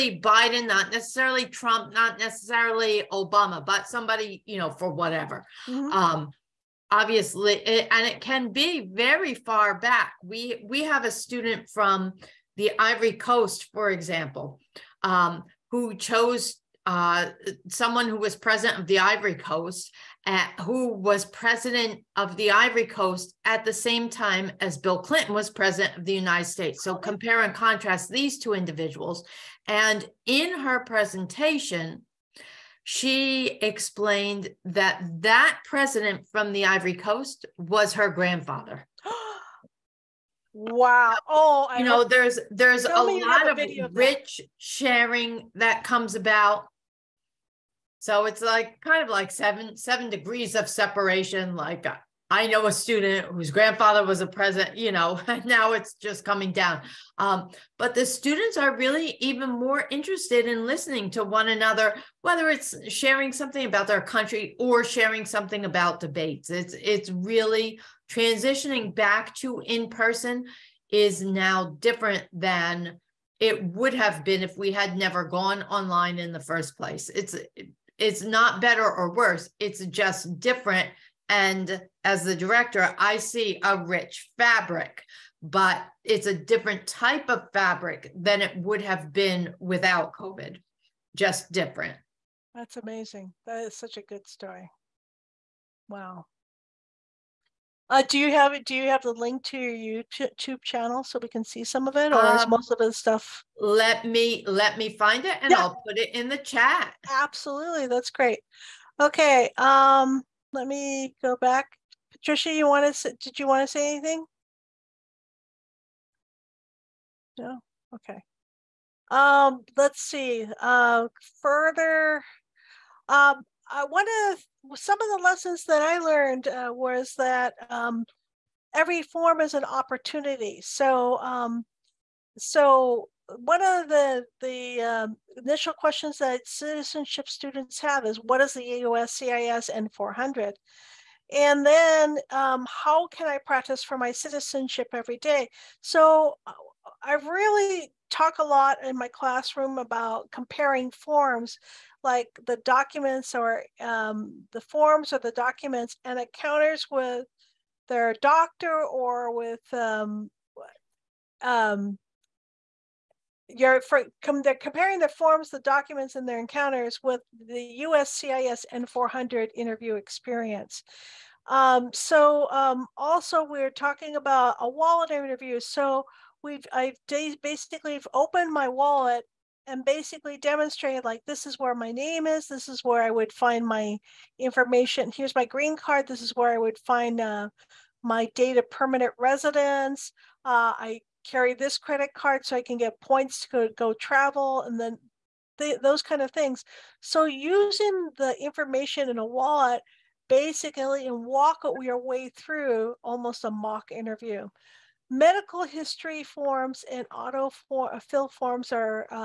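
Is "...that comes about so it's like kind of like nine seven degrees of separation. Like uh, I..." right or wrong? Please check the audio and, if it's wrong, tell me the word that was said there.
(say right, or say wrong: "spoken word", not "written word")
wrong: "seven", not "nine".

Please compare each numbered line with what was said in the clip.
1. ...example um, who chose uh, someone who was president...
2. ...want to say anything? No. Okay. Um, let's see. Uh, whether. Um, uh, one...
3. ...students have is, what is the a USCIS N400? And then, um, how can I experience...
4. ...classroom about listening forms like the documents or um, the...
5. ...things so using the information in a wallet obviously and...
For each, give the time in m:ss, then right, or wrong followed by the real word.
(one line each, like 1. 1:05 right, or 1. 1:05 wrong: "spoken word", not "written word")
1. 0:13 right
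2. 1:53 wrong: "further", not "whether"
3. 2:17 wrong: "practice", not "experience"
4. 2:29 wrong: "comparing", not "listening"
5. 3:16 wrong: "basically", not "obviously".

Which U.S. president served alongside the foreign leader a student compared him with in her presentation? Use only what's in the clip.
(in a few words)
Bill Clinton.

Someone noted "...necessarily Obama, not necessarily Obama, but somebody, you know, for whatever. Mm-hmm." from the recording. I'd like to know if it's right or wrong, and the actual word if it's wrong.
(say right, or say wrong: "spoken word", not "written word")
wrong: "Trump", not "Obama".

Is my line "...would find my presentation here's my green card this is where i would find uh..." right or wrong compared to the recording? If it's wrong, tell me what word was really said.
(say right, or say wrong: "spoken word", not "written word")
wrong: "information", not "presentation".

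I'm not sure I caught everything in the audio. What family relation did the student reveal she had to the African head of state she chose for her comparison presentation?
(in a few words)
Her grandfather.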